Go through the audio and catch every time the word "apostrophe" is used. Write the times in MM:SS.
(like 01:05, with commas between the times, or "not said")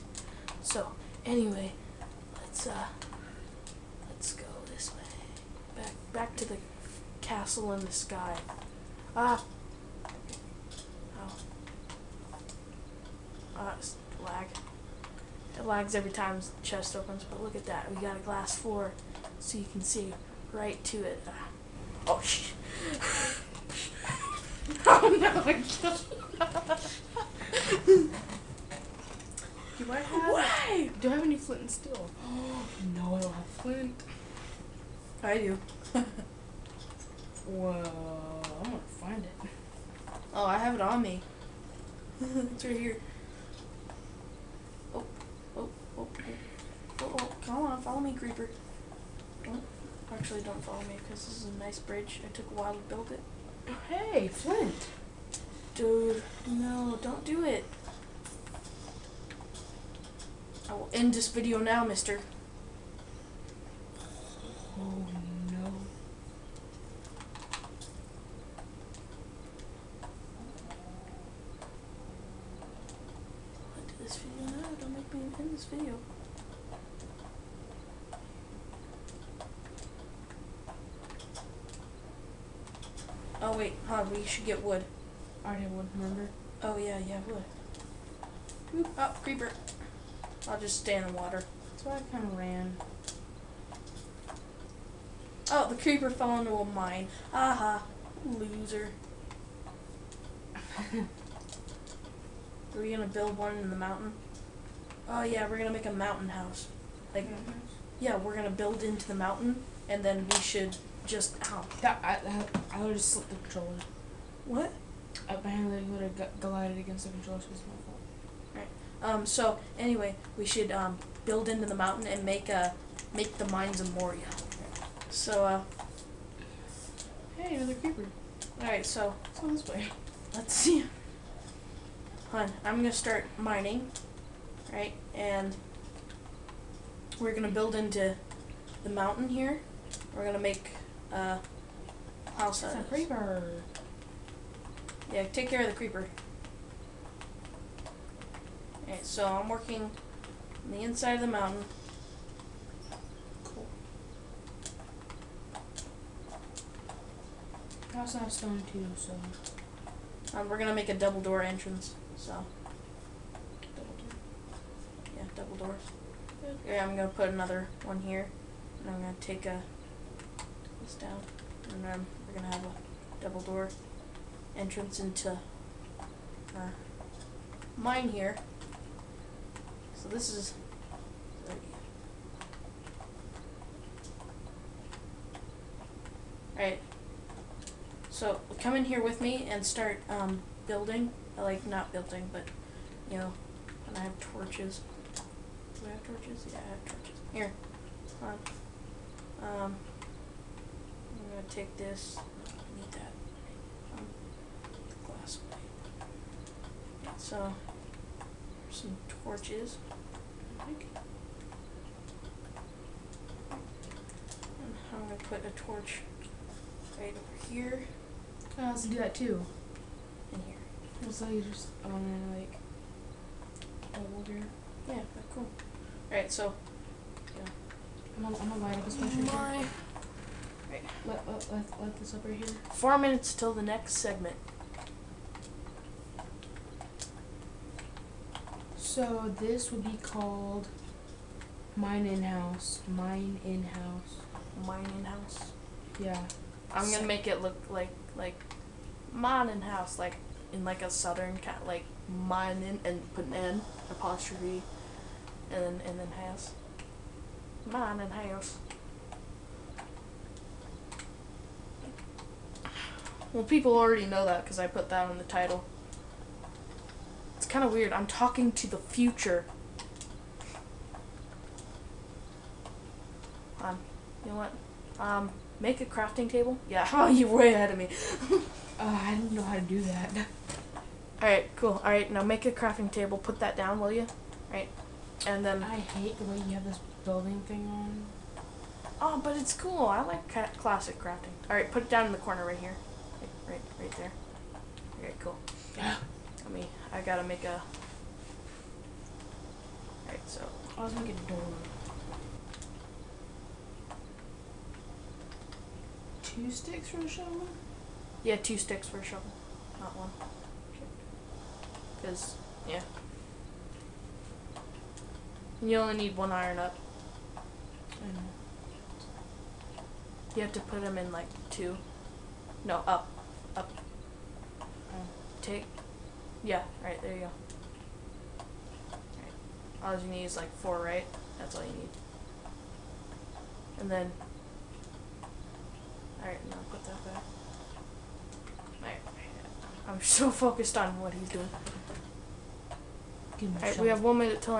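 04:13.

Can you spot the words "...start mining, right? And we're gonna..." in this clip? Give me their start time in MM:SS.
02:12.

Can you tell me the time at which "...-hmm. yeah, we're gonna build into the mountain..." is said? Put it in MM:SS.
01:47.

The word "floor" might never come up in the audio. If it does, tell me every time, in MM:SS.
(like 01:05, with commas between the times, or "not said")
00:18.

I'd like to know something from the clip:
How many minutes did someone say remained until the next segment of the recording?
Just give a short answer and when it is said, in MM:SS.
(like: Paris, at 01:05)
4, at 03:52.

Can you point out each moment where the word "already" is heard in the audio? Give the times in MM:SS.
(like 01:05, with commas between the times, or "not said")
01:25, 04:23.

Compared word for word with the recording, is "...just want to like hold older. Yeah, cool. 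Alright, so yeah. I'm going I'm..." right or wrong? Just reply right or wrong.
right.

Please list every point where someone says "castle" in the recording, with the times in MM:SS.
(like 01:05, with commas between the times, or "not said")
00:07.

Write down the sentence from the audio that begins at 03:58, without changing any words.
So this would be called mine in house.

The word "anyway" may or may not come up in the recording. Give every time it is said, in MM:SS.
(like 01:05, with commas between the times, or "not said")
00:01, 01:59.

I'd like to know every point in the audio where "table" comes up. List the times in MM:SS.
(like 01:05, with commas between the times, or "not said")
04:36, 04:42.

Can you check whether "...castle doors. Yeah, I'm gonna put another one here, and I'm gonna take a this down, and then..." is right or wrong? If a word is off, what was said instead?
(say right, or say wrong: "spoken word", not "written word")
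wrong: "double", not "castle".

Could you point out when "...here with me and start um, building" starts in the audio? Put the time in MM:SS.
03:08.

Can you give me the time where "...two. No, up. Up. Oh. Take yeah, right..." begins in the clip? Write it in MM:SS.
05:21.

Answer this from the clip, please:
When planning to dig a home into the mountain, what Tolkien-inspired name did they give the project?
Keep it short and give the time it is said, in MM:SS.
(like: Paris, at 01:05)
mines of Moria, at 02:03.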